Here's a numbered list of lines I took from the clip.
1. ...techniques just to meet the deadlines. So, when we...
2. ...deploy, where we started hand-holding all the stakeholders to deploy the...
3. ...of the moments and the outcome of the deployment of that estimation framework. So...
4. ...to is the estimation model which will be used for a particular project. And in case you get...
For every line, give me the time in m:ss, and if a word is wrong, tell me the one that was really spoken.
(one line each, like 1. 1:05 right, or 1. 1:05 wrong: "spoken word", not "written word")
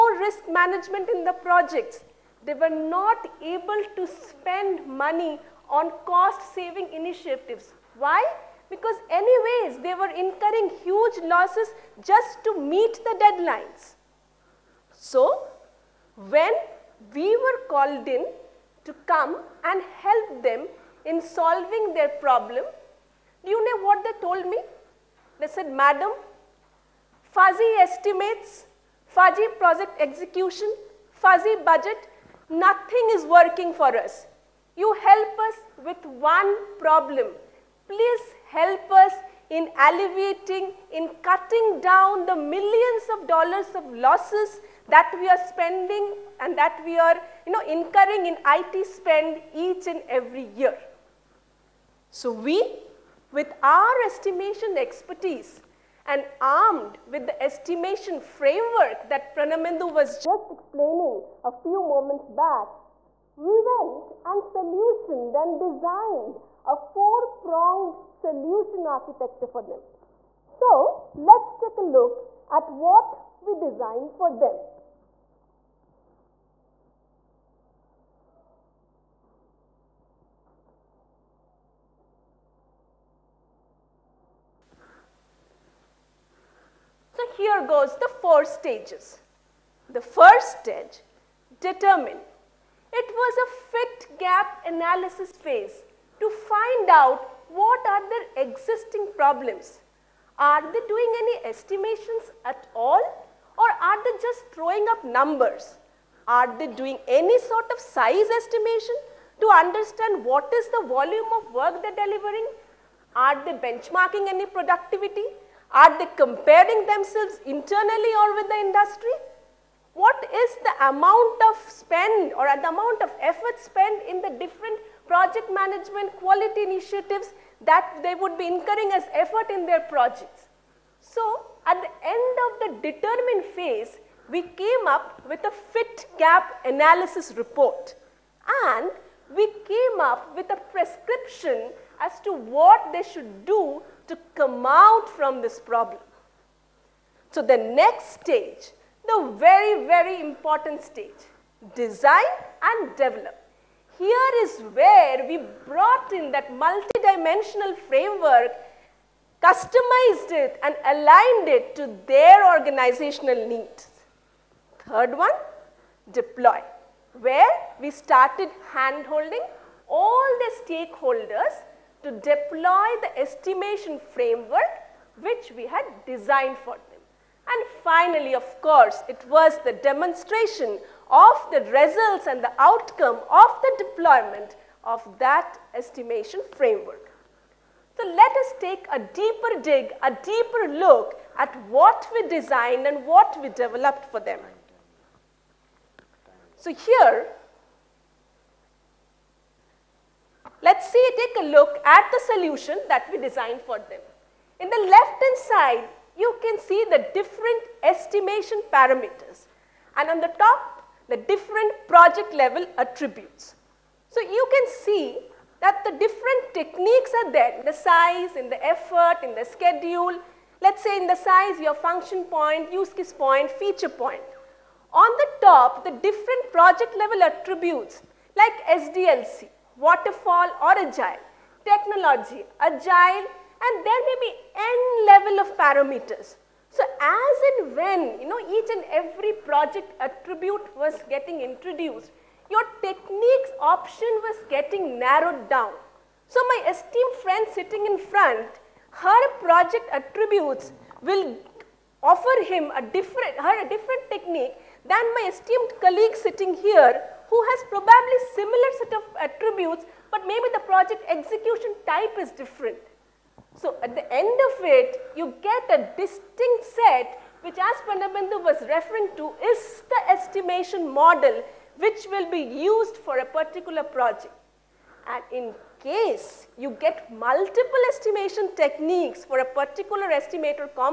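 1. 0:11 wrong: "losses", not "techniques"
2. 2:46 right
3. 3:01 wrong: "results", not "moments"
4. 4:29 right.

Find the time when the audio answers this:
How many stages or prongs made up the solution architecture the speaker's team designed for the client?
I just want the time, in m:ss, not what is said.
1:06.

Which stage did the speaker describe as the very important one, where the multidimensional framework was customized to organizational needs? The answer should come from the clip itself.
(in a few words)
Design and develop.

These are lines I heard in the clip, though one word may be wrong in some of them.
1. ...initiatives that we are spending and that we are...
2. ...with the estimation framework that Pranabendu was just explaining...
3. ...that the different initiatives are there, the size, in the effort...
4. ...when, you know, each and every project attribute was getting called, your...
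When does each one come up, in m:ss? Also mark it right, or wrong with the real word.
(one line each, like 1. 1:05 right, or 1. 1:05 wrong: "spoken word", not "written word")
1. 0:43 wrong: "losses", not "initiatives"
2. 0:57 right
3. 3:35 wrong: "techniques", not "initiatives"
4. 3:57 wrong: "introduced", not "called".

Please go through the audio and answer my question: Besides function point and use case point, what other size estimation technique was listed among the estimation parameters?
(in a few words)
Feature point.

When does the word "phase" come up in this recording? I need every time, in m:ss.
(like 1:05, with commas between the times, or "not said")
1:35, 2:13.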